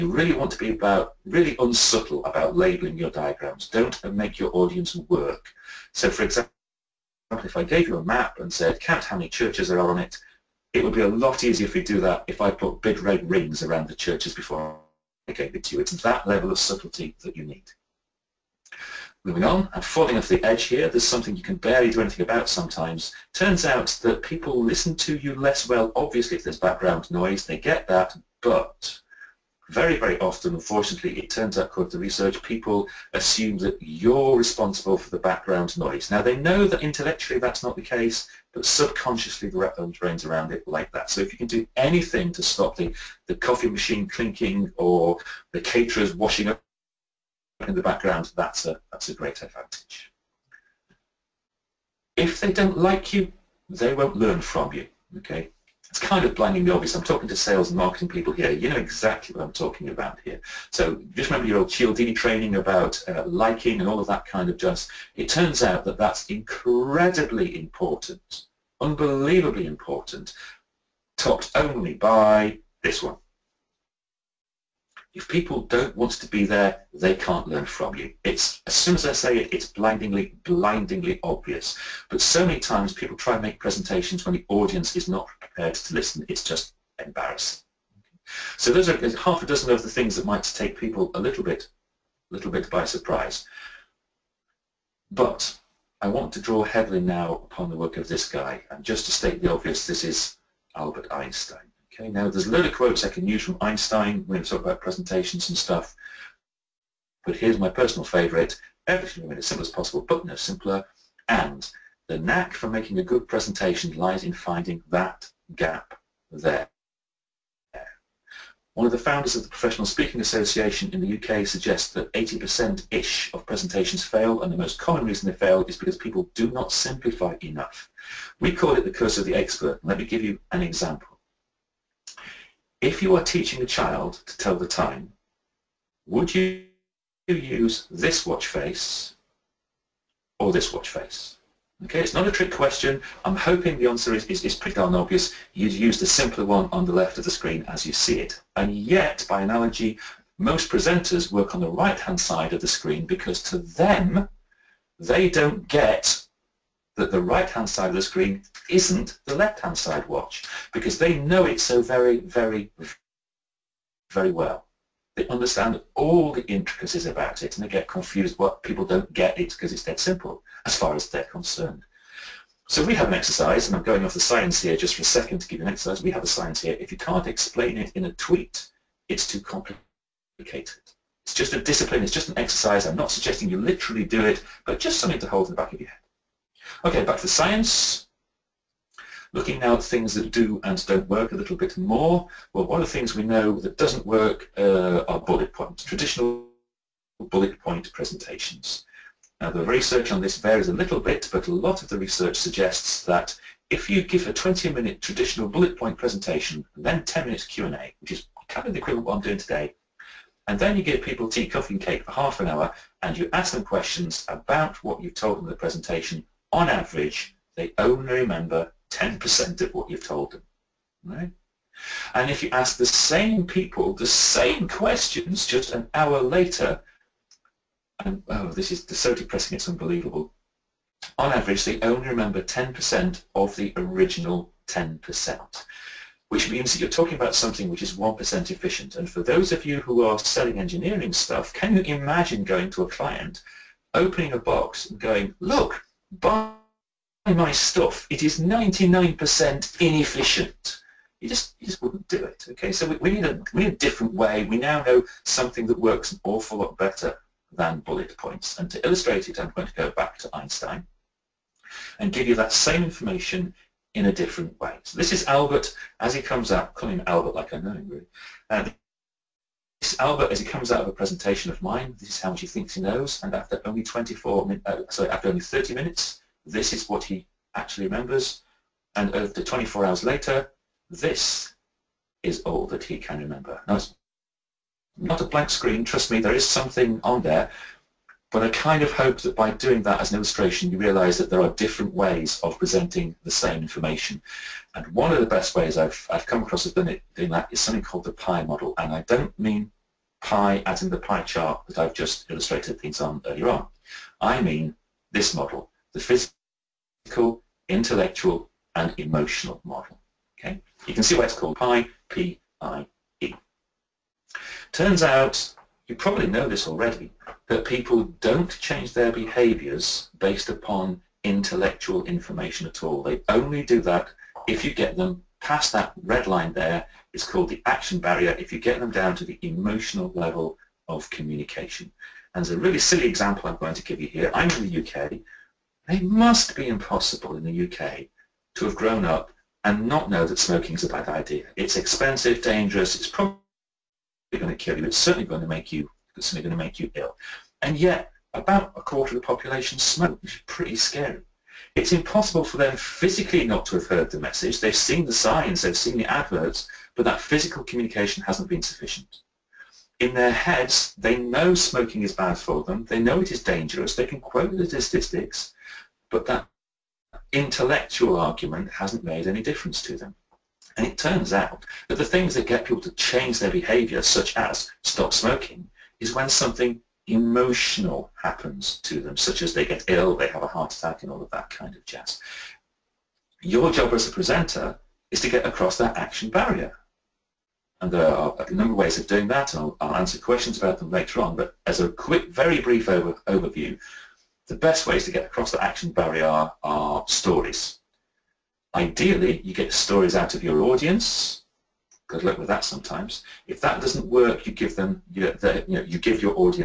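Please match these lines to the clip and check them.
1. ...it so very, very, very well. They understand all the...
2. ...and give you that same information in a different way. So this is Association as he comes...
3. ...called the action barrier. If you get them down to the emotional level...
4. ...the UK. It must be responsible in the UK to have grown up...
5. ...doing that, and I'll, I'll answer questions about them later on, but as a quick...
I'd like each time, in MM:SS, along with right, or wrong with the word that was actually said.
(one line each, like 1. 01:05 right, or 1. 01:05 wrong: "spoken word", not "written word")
1. 02:41 right
2. 04:21 wrong: "Albert", not "Association"
3. 05:27 right
4. 05:34 wrong: "impossible", not "responsible"
5. 06:29 right.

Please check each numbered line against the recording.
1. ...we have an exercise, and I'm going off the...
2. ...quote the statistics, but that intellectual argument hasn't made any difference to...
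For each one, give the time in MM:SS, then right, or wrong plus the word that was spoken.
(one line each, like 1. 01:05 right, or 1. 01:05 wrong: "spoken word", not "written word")
1. 02:52 right
2. 06:04 right.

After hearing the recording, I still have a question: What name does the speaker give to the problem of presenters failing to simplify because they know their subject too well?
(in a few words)
the curse of the expert.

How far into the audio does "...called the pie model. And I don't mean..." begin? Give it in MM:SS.
04:57.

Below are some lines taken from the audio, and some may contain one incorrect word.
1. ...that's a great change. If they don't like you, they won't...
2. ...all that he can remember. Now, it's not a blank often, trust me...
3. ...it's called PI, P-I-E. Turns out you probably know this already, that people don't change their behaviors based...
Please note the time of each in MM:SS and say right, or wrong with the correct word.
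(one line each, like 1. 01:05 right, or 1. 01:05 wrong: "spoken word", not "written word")
1. 00:48 wrong: "advantage", not "change"
2. 04:42 wrong: "screen", not "often"
3. 05:11 right.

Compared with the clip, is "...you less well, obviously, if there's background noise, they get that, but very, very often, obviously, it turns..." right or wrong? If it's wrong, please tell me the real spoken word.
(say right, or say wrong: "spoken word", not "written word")
wrong: "unfortunately", not "obviously".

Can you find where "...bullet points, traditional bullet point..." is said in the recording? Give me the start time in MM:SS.
03:15.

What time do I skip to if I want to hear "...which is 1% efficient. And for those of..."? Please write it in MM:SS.
03:57.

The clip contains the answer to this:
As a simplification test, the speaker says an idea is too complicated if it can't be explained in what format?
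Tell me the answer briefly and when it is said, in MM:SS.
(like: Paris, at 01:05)
a tweet, at 02:58.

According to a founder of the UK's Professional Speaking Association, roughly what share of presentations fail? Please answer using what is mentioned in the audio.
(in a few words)
80%.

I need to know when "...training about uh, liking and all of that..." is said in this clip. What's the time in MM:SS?
01:02.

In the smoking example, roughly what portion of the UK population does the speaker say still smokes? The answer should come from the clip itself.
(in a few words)
a quarter.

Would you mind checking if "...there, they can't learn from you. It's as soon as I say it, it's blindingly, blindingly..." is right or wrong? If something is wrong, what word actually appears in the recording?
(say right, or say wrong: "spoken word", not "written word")
right.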